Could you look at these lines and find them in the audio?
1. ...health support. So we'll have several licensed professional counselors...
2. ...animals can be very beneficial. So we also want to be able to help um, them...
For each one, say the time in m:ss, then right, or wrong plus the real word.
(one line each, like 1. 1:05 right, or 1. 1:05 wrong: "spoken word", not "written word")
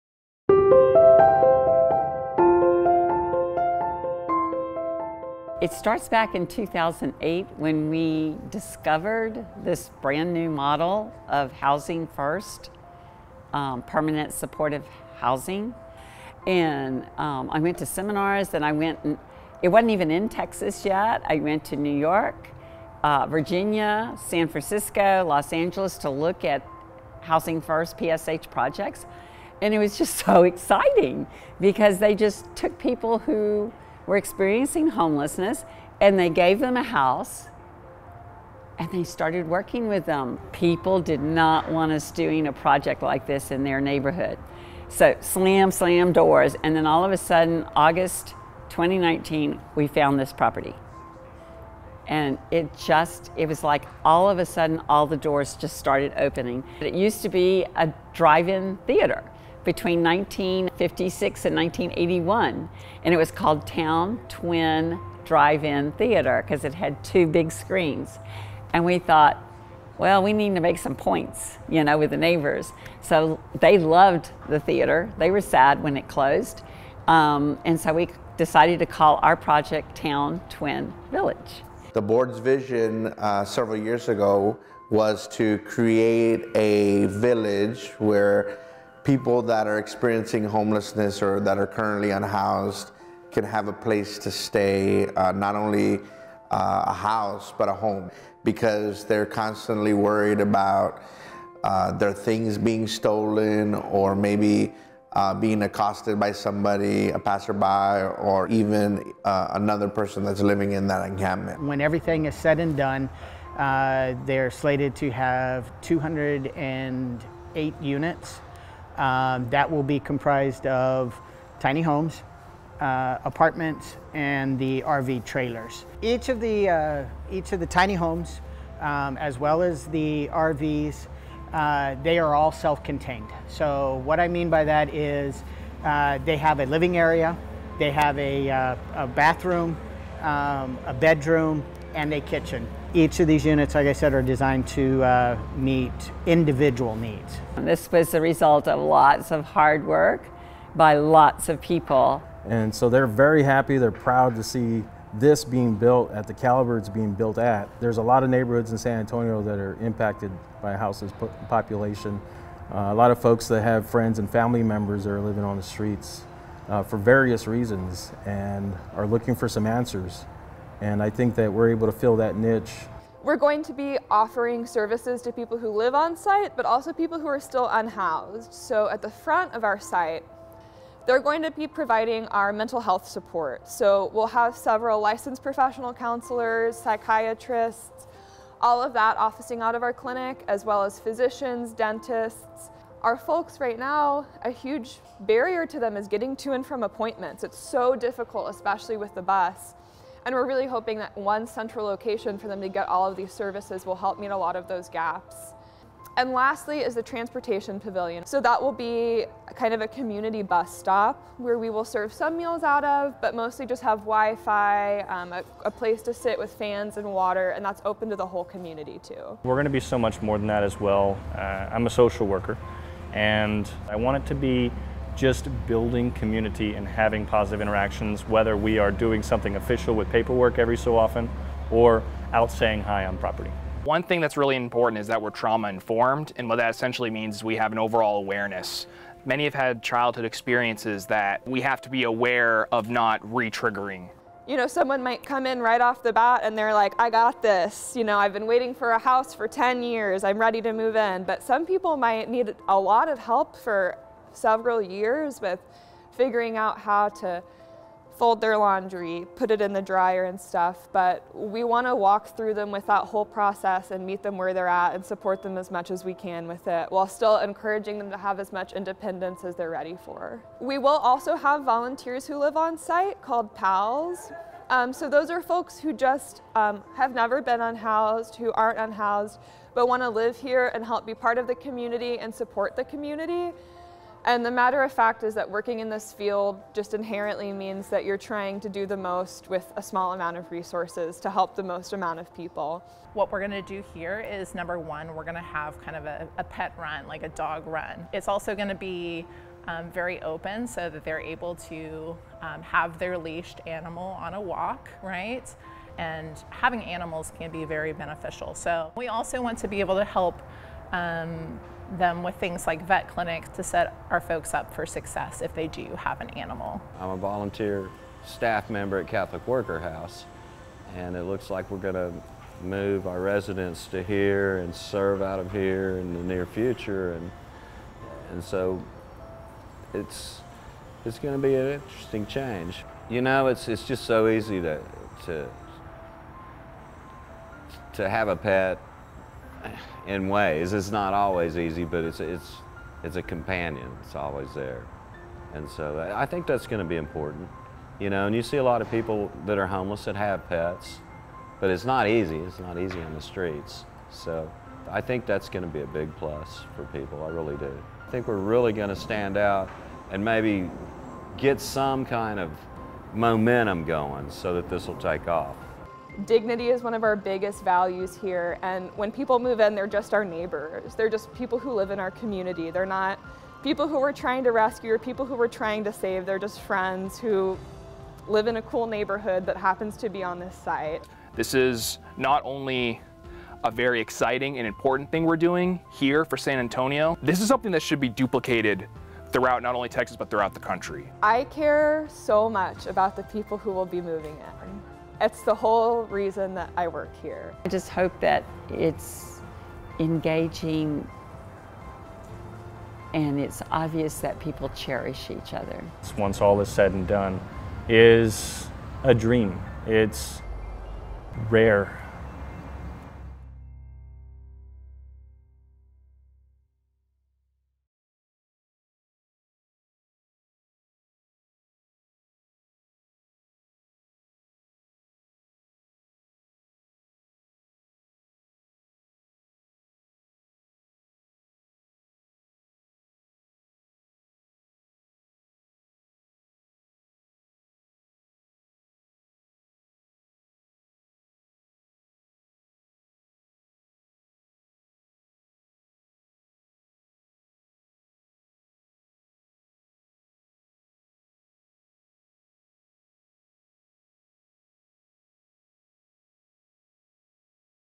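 1. 3:02 right
2. 5:06 right.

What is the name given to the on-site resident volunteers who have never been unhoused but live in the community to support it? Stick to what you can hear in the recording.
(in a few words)
PALs.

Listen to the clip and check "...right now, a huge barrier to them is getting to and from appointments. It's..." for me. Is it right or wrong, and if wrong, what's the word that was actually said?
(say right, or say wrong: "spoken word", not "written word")
right.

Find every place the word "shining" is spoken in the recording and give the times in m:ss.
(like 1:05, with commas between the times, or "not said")
not said.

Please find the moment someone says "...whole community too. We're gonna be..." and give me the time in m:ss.
3:38.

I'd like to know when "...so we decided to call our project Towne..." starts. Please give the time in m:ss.
1:17.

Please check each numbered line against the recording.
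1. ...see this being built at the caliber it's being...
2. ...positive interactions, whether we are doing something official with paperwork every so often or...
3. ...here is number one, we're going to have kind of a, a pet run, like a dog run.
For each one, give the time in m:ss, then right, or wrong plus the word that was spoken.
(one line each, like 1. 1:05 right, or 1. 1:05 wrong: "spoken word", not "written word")
1. 2:34 right
2. 3:47 right
3. 4:53 right.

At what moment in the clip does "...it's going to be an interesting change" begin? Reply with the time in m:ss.
5:31.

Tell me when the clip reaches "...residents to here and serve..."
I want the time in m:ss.
5:23.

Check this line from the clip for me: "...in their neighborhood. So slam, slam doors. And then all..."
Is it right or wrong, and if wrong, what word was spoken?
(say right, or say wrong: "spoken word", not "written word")
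right.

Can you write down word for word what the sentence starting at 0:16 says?
And um, I went to seminars, then I went, and it wasn't even in Texas yet.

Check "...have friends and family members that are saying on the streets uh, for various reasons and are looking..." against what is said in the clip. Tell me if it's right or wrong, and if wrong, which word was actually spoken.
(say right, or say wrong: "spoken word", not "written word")
wrong: "living", not "saying".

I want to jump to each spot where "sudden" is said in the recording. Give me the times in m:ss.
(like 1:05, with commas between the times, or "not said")
0:47, 0:54.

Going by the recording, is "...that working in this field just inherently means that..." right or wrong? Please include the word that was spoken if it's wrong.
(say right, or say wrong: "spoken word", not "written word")
right.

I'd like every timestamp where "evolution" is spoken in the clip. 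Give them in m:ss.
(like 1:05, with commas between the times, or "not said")
not said.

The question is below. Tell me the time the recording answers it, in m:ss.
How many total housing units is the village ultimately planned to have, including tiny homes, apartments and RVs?
1:55.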